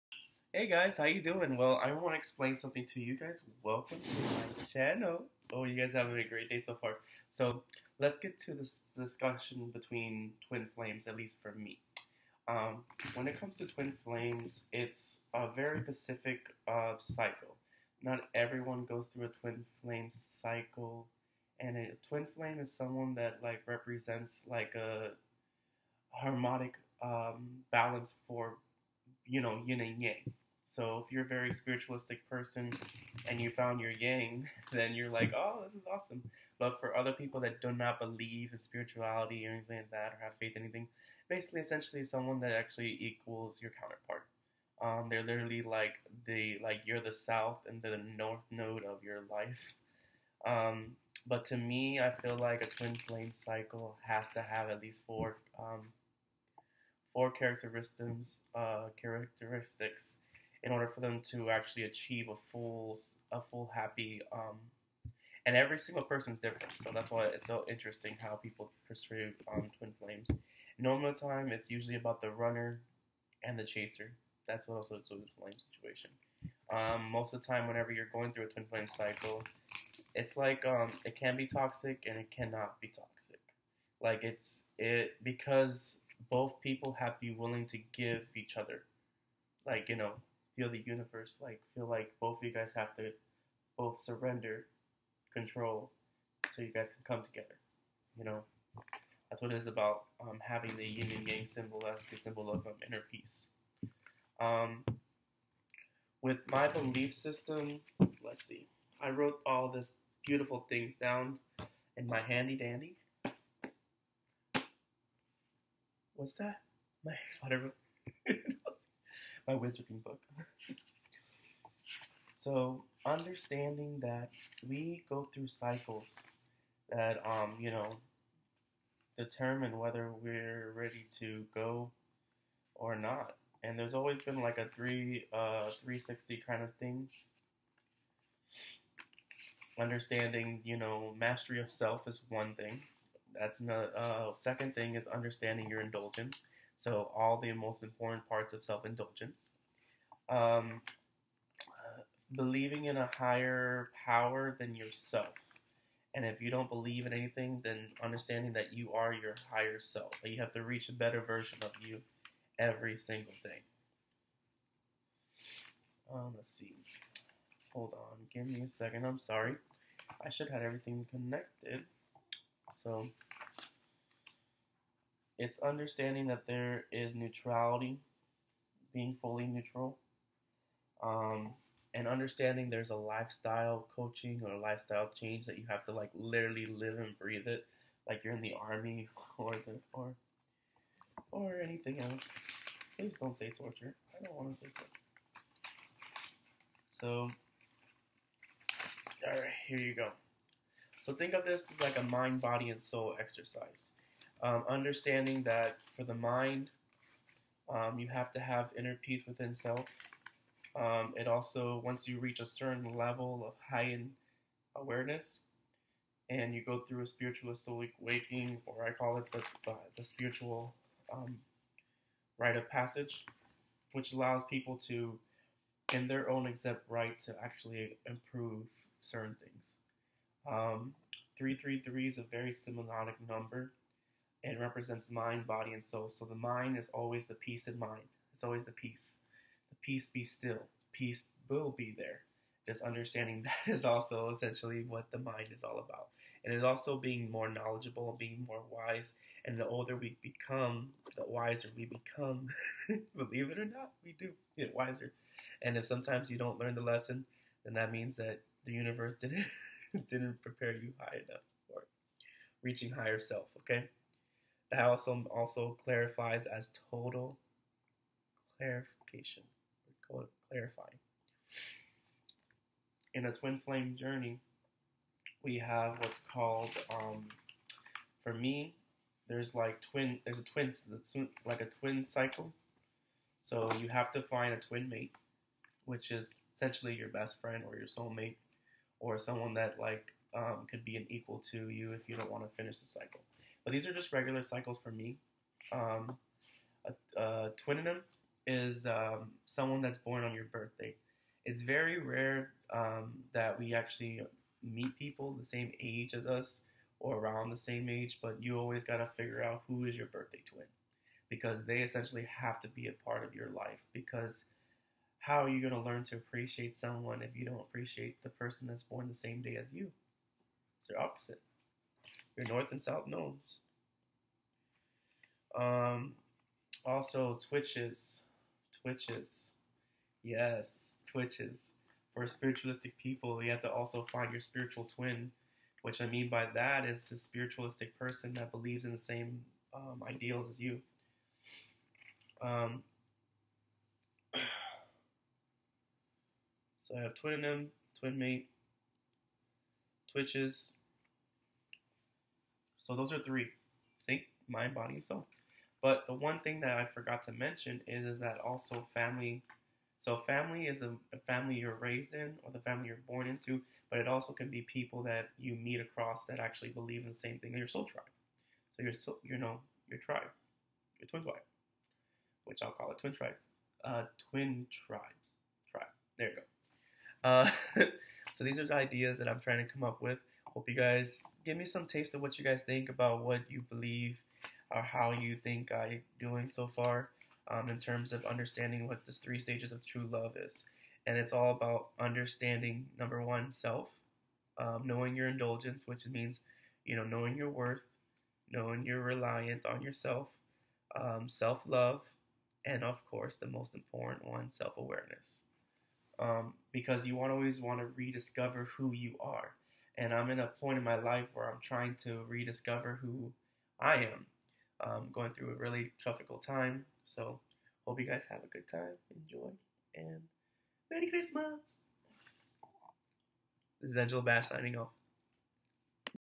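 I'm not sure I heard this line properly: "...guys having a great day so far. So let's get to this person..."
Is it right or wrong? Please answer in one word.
wrong.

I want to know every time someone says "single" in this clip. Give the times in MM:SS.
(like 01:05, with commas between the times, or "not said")
01:05, 02:42.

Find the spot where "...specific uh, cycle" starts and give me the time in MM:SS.
00:15.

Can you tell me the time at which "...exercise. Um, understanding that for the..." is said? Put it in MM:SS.
03:23.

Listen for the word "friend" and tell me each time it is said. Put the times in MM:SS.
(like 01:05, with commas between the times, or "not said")
04:47.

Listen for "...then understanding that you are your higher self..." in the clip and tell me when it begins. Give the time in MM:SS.
02:37.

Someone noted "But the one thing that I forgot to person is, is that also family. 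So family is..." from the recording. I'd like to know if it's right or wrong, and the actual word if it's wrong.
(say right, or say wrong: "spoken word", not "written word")
wrong: "mention", not "person".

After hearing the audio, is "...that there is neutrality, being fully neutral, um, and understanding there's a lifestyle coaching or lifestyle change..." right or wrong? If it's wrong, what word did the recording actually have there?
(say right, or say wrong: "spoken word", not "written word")
right.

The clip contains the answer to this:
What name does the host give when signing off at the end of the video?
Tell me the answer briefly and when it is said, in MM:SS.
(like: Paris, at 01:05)
Angelo Bash, at 07:03.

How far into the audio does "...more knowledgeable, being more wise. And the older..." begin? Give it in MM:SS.
04:07.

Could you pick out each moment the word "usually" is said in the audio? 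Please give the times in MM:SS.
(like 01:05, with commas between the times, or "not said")
01:11.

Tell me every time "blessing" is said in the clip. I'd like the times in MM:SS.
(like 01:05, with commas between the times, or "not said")
not said.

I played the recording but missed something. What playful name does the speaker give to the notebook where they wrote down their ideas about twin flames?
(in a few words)
wizarding book.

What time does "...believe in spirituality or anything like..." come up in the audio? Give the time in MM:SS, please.
00:37.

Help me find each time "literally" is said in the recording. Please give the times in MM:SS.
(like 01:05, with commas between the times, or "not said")
00:45, 03:06.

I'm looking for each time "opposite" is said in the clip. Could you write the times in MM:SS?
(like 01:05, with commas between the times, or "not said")
05:20.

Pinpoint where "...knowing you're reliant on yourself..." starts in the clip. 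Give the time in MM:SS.
06:38.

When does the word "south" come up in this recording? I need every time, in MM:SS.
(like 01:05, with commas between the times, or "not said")
00:47, 05:22.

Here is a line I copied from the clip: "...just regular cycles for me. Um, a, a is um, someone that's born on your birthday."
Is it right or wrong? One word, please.
right.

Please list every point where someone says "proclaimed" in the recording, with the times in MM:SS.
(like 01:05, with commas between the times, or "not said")
not said.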